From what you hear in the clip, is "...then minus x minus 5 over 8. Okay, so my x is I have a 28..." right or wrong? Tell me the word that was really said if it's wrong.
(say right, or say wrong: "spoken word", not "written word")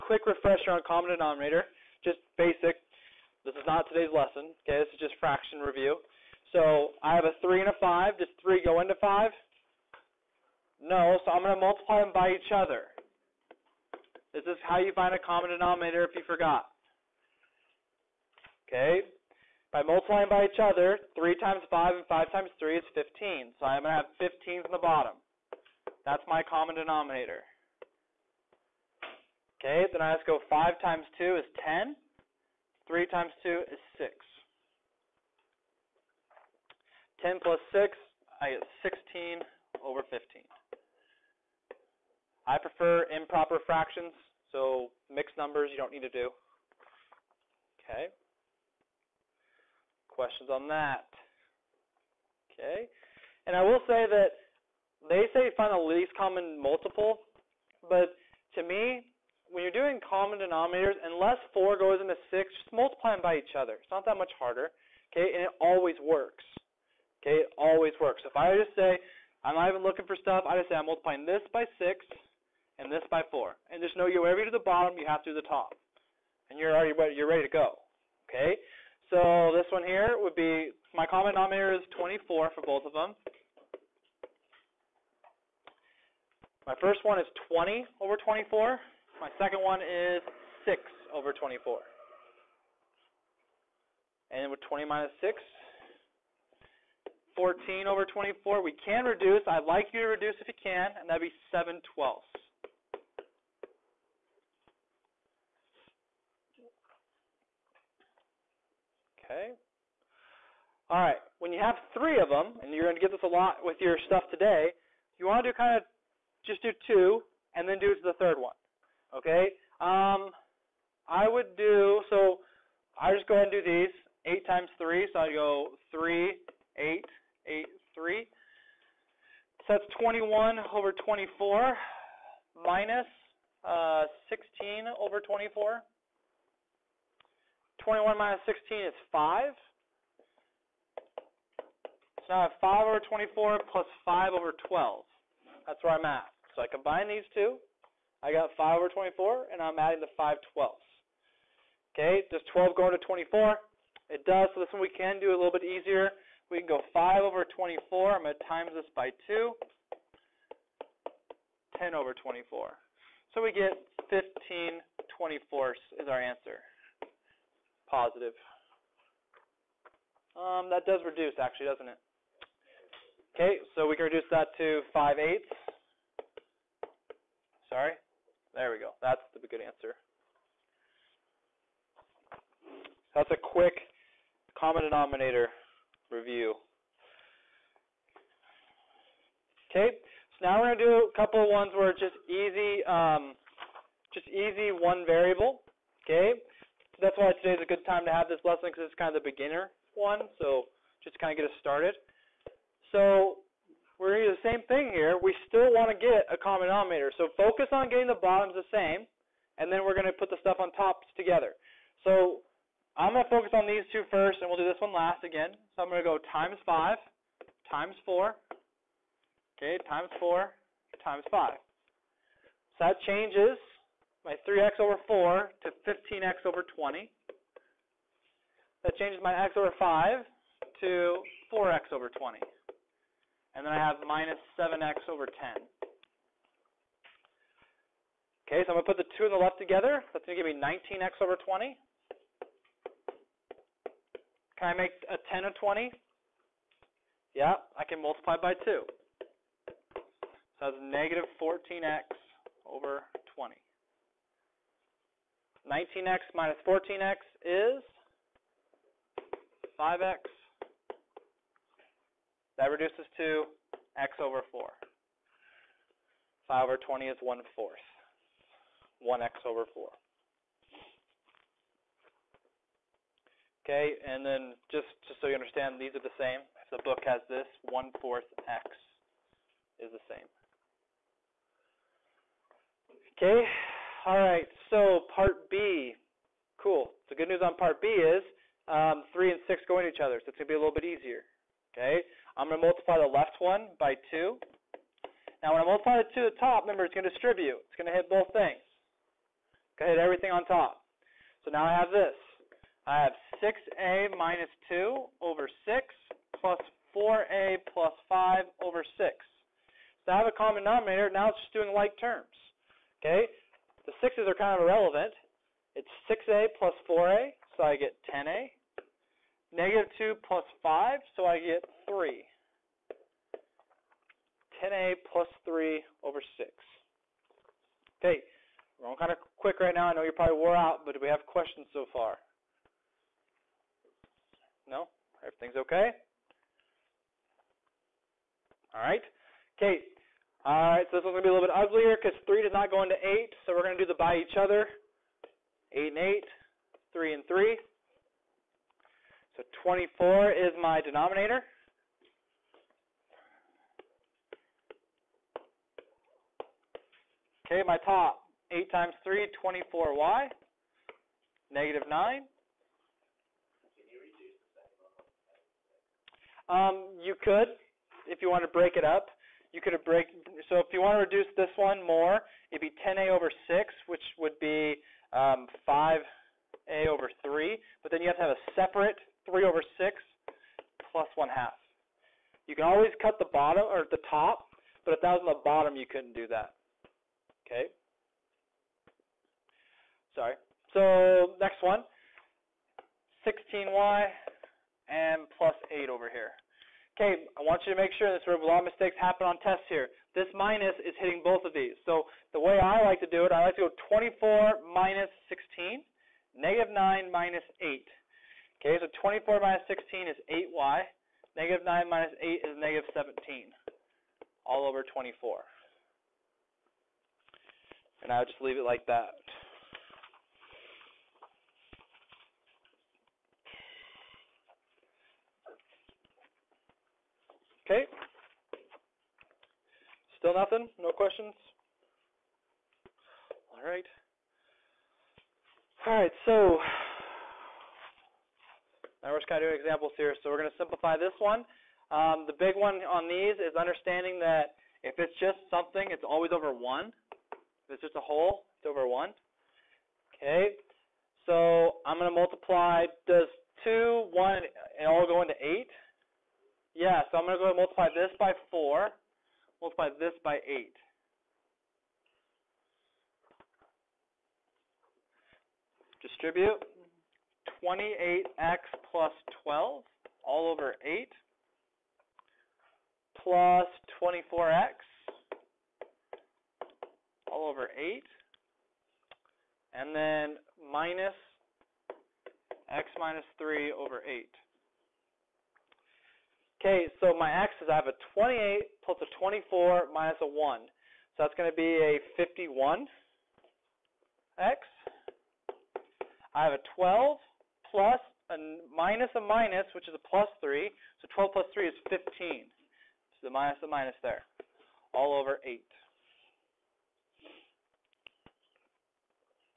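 wrong: "3", not "5".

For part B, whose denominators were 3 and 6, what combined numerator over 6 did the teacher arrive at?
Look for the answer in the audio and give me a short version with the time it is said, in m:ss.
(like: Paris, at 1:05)
10a + 3, at 5:24.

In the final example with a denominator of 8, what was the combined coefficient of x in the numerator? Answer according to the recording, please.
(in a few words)
51.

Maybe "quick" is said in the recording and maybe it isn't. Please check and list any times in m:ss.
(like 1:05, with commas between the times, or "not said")
3:03, 5:29.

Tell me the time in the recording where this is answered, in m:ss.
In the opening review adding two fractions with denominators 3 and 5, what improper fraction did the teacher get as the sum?
0:38.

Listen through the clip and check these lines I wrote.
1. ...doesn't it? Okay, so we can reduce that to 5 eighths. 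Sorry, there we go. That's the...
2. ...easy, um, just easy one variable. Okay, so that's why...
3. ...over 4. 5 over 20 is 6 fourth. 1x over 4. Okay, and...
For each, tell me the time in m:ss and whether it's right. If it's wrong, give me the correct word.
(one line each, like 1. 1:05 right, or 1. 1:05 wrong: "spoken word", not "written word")
1. 2:51 right
2. 3:12 right
3. 4:24 wrong: "1", not "6".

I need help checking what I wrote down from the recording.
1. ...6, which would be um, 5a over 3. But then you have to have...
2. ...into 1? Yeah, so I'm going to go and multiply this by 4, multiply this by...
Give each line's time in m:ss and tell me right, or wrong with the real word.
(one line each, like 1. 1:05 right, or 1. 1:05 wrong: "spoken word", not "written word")
1. 6:13 right
2. 7:35 wrong: "8", not "1".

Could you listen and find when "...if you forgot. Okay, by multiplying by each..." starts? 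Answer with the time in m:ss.
0:16.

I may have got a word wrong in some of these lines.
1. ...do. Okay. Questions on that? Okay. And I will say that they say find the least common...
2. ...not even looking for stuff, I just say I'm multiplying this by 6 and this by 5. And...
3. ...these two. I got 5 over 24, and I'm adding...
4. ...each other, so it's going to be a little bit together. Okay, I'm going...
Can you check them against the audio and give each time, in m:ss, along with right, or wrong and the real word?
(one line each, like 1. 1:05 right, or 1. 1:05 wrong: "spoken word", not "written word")
1. 0:46 right
2. 1:09 wrong: "4", not "5"
3. 2:27 right
4. 4:49 wrong: "easier", not "together".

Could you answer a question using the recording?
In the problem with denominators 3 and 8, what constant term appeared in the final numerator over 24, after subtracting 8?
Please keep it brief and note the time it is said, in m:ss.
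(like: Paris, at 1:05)
-17, at 6:52.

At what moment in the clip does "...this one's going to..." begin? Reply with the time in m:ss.
5:40.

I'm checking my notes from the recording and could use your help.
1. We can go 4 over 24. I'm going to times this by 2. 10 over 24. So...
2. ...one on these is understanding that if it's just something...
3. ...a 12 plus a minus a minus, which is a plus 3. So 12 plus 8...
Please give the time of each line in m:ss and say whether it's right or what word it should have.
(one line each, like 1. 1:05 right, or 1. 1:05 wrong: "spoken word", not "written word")
1. 2:36 wrong: "5", not "4"
2. 7:22 right
3. 8:16 wrong: "3", not "8".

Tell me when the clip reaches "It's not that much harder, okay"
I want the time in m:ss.
1:03.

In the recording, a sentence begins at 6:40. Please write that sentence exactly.
This minus is hitting both of these.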